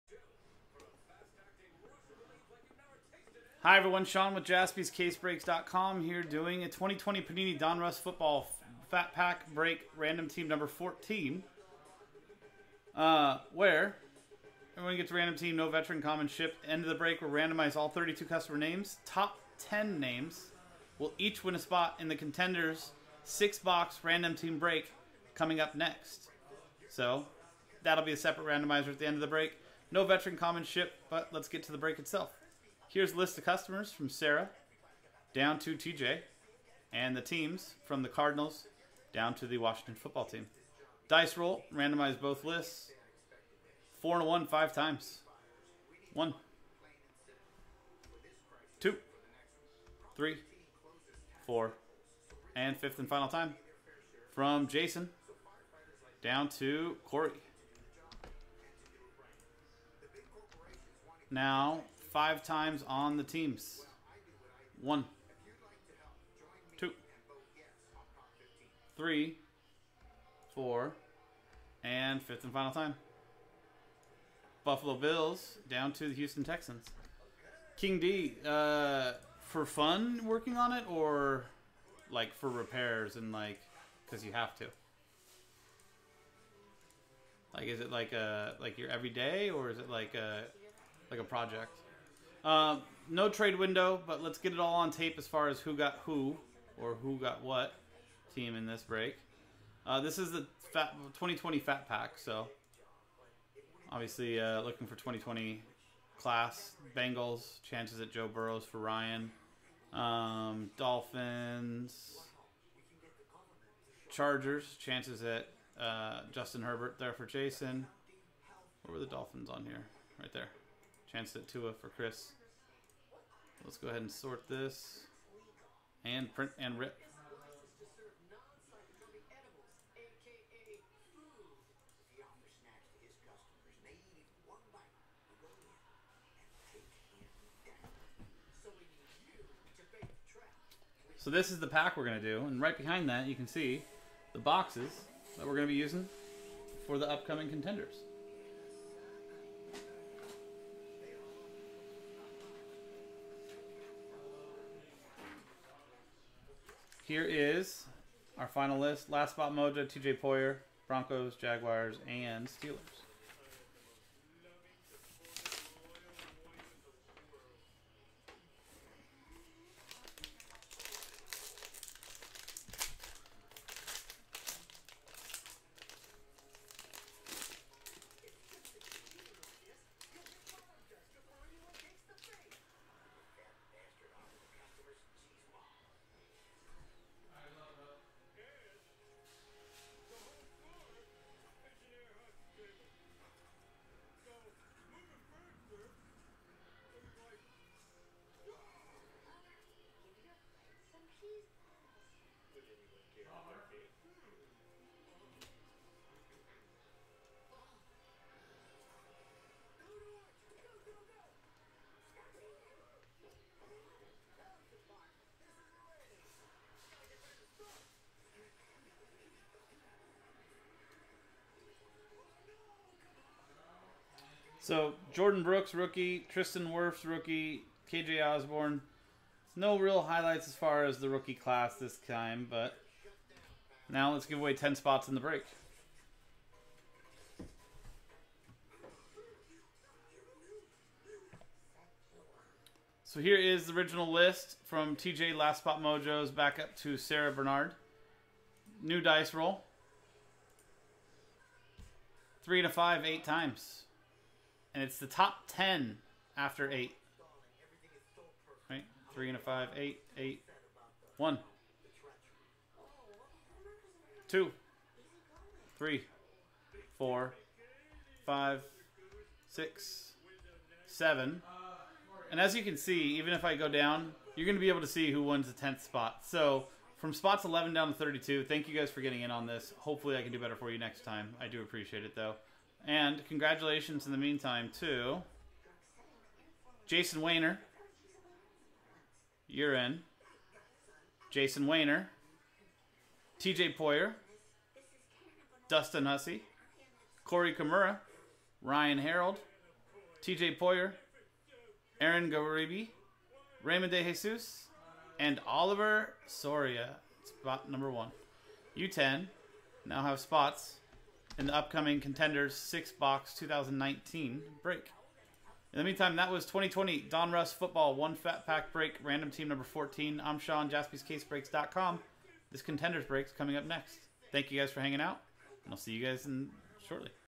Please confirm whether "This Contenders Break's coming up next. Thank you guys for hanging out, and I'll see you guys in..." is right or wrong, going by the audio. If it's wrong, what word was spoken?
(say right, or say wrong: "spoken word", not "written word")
right.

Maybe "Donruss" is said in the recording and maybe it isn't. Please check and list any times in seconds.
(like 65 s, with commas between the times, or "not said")
7 s, 317 s.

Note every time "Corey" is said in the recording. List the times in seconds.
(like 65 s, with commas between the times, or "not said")
57 s, 297 s.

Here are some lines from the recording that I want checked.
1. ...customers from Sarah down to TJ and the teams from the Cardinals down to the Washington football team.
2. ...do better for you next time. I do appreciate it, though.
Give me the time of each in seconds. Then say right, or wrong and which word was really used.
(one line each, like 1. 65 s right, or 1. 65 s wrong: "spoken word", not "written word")
1. 33 s right
2. 280 s right.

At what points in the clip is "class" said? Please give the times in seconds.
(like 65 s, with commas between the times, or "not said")
106 s, 231 s.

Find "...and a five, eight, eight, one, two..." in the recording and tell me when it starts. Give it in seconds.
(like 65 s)
259 s.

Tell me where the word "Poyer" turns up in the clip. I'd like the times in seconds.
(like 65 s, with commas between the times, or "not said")
160 s, 293 s, 300 s.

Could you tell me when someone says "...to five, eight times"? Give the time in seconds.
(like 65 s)
252 s.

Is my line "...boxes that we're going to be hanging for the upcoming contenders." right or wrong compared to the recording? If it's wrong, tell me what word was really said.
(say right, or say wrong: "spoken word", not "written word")
wrong: "using", not "hanging".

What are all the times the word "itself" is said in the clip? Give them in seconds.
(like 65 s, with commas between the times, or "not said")
31 s.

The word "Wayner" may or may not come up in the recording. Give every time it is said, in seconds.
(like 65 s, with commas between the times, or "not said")
287 s, 291 s.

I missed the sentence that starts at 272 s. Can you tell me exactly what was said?
And as you can see, even if I go down, you're going to be able to see who wins the 10th spot.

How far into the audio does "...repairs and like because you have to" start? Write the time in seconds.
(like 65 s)
82 s.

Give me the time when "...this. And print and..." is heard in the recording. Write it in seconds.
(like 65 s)
124 s.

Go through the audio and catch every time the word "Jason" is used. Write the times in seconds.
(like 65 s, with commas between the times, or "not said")
54 s, 117 s, 286 s, 291 s.